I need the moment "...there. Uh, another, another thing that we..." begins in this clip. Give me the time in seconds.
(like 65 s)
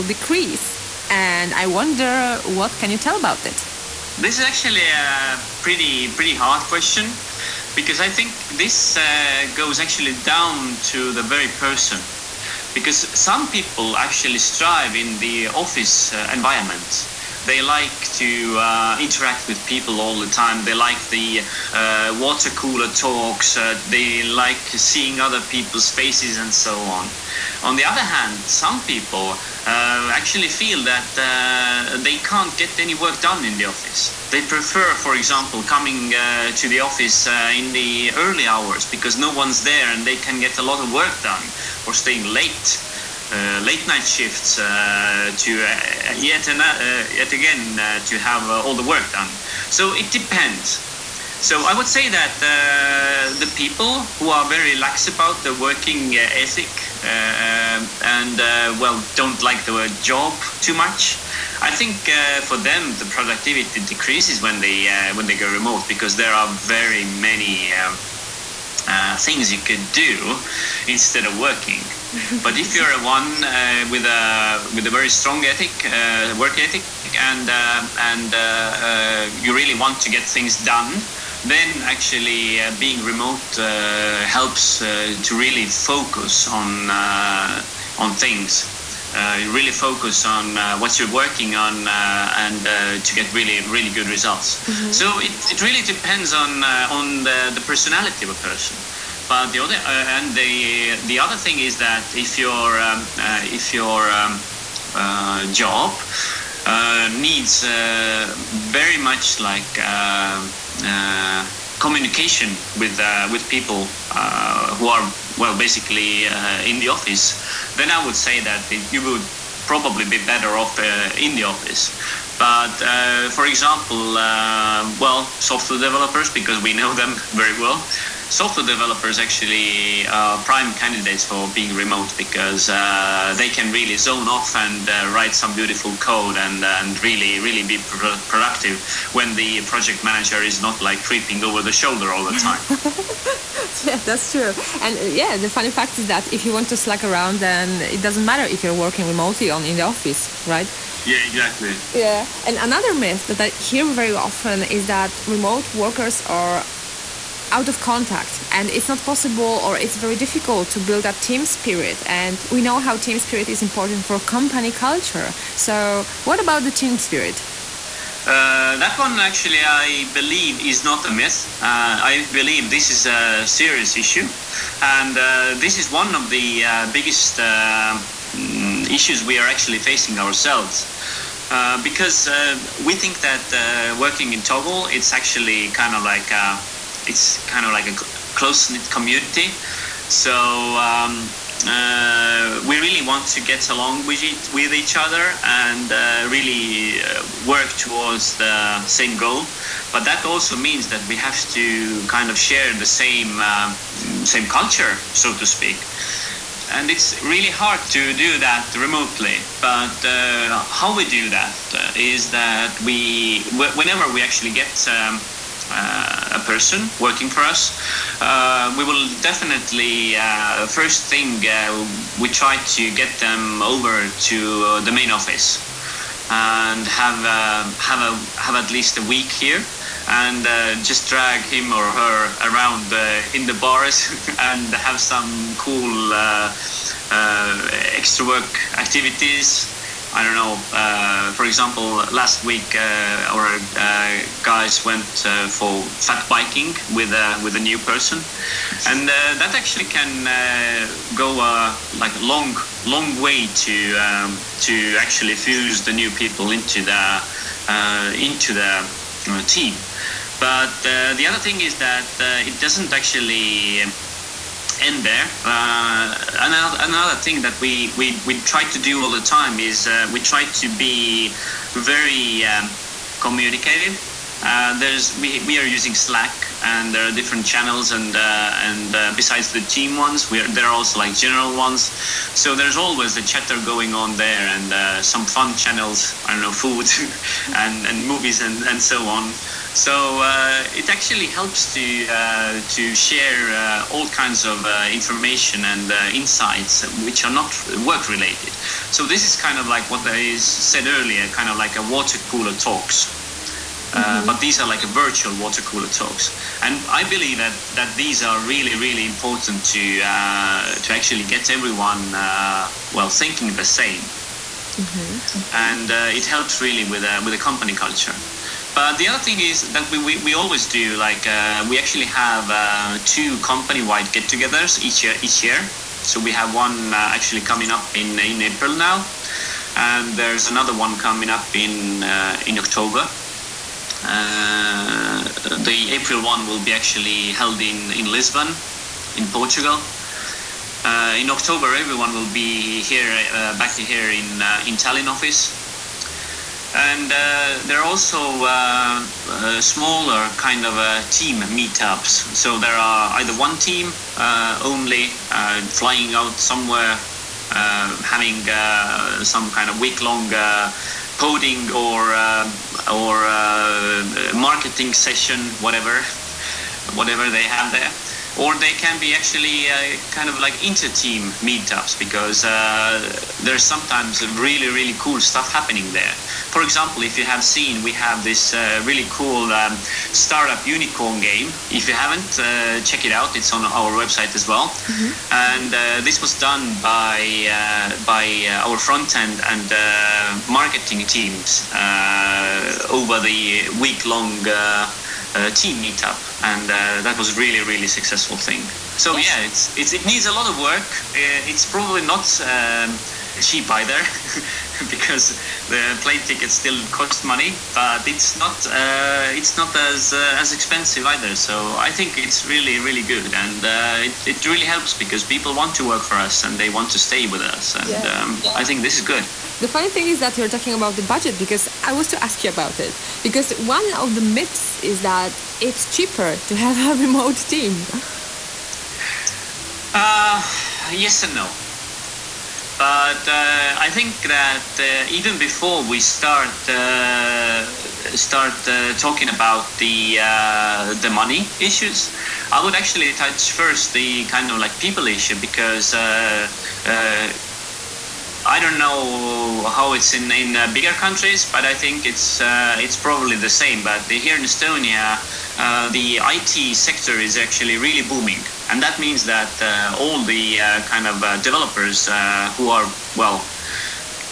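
265 s.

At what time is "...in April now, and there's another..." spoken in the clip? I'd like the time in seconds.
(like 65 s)
328 s.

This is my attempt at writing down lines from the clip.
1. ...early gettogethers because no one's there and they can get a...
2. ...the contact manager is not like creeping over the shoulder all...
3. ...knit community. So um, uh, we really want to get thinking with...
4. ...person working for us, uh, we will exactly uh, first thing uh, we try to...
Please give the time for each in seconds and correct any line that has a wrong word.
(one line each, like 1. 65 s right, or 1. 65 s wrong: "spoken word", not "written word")
1. 38 s wrong: "hours", not "gettogethers"
2. 139 s wrong: "project", not "contact"
3. 188 s wrong: "along", not "thinking"
4. 216 s wrong: "definitely", not "exactly".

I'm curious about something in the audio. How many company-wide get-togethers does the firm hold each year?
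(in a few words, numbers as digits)
2.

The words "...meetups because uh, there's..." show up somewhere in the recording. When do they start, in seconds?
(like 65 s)
371 s.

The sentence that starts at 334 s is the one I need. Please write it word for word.
Uh, the April one will be actually held in in Lisbon, in Portugal.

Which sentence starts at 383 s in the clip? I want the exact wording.
It's on our website as well.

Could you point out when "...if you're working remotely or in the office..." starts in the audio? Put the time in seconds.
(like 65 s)
148 s.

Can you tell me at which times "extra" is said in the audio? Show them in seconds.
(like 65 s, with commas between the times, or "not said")
237 s.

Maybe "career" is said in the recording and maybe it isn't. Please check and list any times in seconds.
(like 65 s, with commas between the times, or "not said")
not said.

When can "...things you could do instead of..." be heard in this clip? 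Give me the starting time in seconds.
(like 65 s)
69 s.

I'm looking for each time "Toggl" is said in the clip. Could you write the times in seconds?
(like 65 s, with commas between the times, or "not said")
184 s.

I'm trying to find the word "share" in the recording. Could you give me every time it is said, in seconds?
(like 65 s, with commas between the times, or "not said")
202 s, 292 s.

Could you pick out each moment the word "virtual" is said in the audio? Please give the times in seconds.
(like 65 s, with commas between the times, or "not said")
304 s.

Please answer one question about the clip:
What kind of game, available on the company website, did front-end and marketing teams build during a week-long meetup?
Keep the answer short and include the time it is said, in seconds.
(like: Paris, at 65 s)
Startup unicorn game, at 380 s.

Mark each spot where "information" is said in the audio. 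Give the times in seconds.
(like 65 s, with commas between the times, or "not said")
294 s.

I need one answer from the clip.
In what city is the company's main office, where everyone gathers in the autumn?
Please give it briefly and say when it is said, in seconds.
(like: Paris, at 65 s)
Tallinn, at 344 s.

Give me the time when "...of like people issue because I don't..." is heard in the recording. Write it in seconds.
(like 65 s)
444 s.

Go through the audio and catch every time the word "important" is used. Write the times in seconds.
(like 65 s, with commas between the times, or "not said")
163 s, 309 s.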